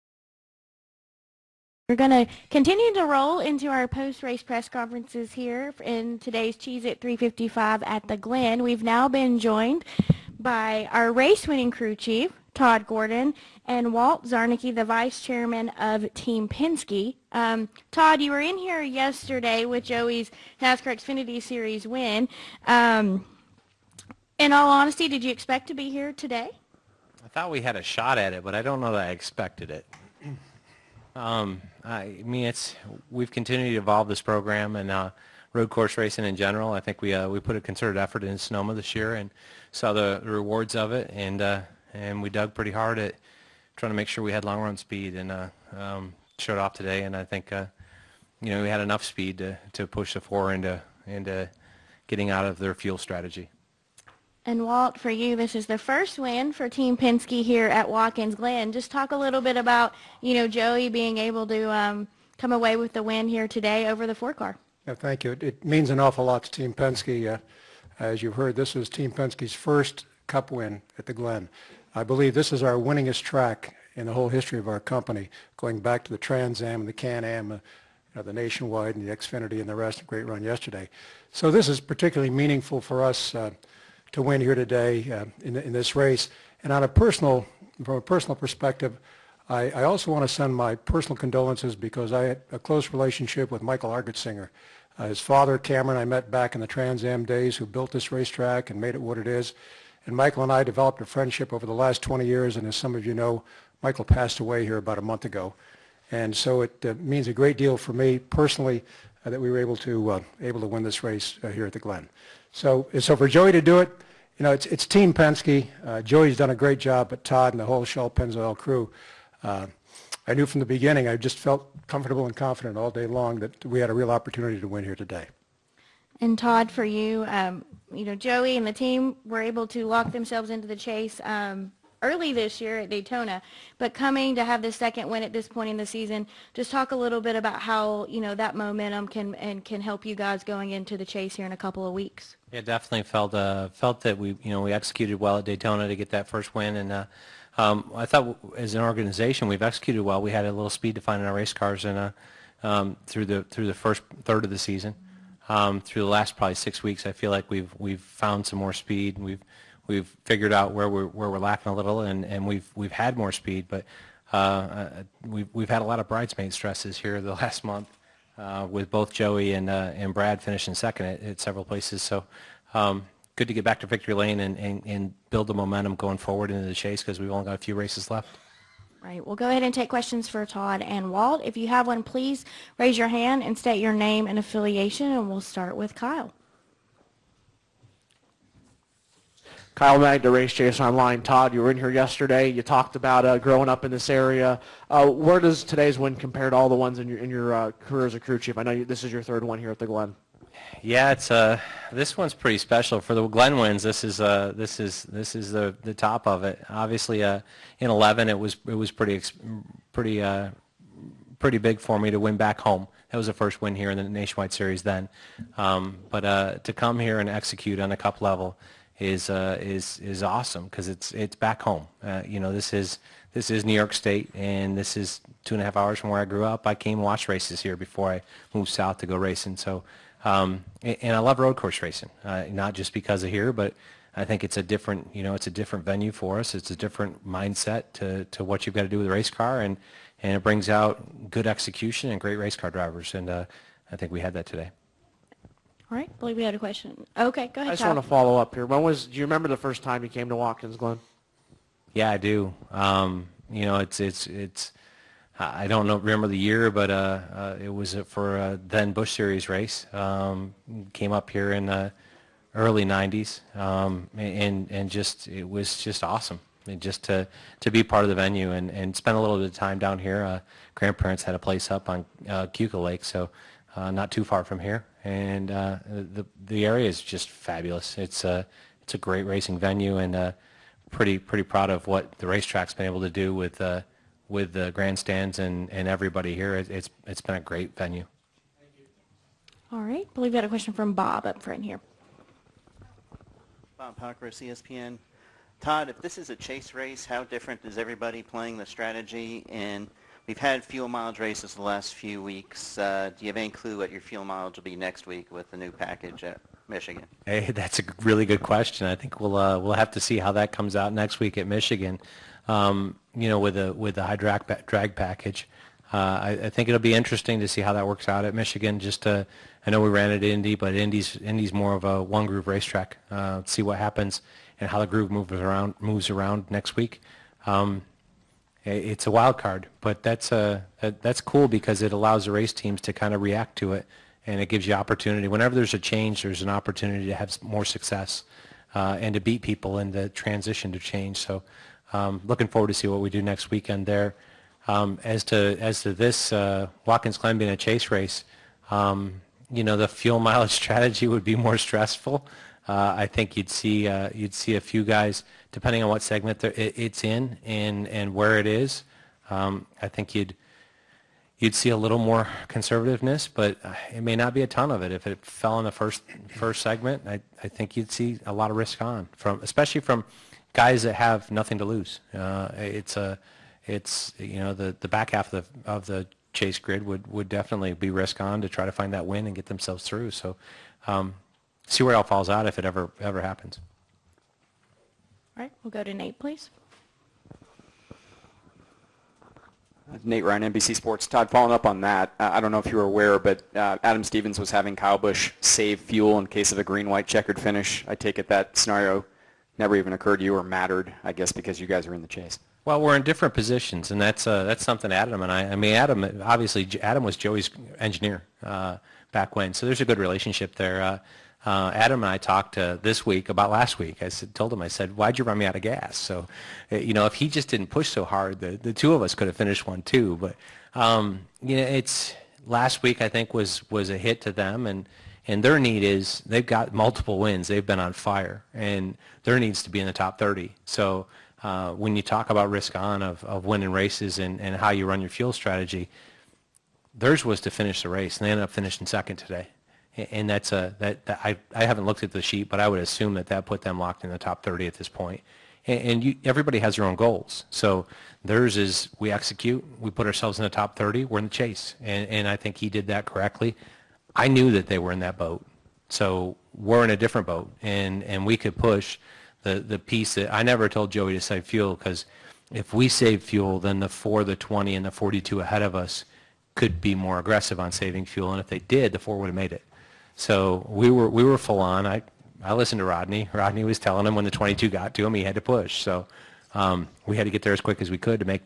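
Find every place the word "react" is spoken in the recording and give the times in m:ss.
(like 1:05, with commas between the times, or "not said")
5:33.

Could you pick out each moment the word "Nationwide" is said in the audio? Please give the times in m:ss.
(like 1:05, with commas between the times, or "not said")
1:18, 3:34.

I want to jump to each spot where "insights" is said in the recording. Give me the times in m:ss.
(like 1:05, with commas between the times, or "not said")
not said.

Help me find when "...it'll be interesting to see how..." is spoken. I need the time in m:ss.
5:16.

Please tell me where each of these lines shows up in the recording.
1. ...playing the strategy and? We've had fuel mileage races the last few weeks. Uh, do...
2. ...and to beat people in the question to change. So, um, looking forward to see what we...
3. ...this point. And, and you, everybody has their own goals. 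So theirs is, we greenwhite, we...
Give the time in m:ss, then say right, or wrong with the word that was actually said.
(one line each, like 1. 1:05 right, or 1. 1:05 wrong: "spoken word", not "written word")
1. 4:58 right
2. 5:38 wrong: "transition", not "question"
3. 7:24 wrong: "execute", not "greenwhite".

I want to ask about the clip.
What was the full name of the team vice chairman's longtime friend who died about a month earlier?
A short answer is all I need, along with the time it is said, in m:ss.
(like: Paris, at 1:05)
Michael Argetsinger, at 1:33.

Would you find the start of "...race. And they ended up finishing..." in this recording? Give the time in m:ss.
7:17.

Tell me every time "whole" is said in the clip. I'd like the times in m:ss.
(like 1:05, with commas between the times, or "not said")
1:14, 1:57.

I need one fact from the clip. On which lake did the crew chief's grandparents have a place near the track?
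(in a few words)
Keuka Lake.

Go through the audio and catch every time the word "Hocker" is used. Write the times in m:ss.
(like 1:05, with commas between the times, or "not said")
4:53.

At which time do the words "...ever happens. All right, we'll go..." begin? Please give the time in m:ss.
6:22.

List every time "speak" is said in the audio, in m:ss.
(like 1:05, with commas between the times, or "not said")
not said.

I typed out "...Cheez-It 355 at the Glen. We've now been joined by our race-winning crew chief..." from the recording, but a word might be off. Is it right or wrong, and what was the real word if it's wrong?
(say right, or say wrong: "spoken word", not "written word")
right.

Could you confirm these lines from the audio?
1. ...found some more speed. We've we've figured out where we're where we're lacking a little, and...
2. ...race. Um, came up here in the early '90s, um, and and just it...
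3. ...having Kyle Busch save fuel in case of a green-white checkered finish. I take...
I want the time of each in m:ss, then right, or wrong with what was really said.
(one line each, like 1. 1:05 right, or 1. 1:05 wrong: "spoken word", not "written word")
1. 2:37 right
2. 4:19 right
3. 6:34 right.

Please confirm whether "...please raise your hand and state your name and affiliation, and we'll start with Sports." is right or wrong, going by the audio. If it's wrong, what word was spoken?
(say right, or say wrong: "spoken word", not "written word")
wrong: "Kyle", not "Sports".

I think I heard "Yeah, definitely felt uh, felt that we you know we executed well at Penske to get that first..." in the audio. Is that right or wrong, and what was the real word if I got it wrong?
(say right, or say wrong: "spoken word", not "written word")
wrong: "Daytona", not "Penske".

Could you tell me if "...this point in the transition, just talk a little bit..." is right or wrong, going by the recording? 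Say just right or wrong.
wrong.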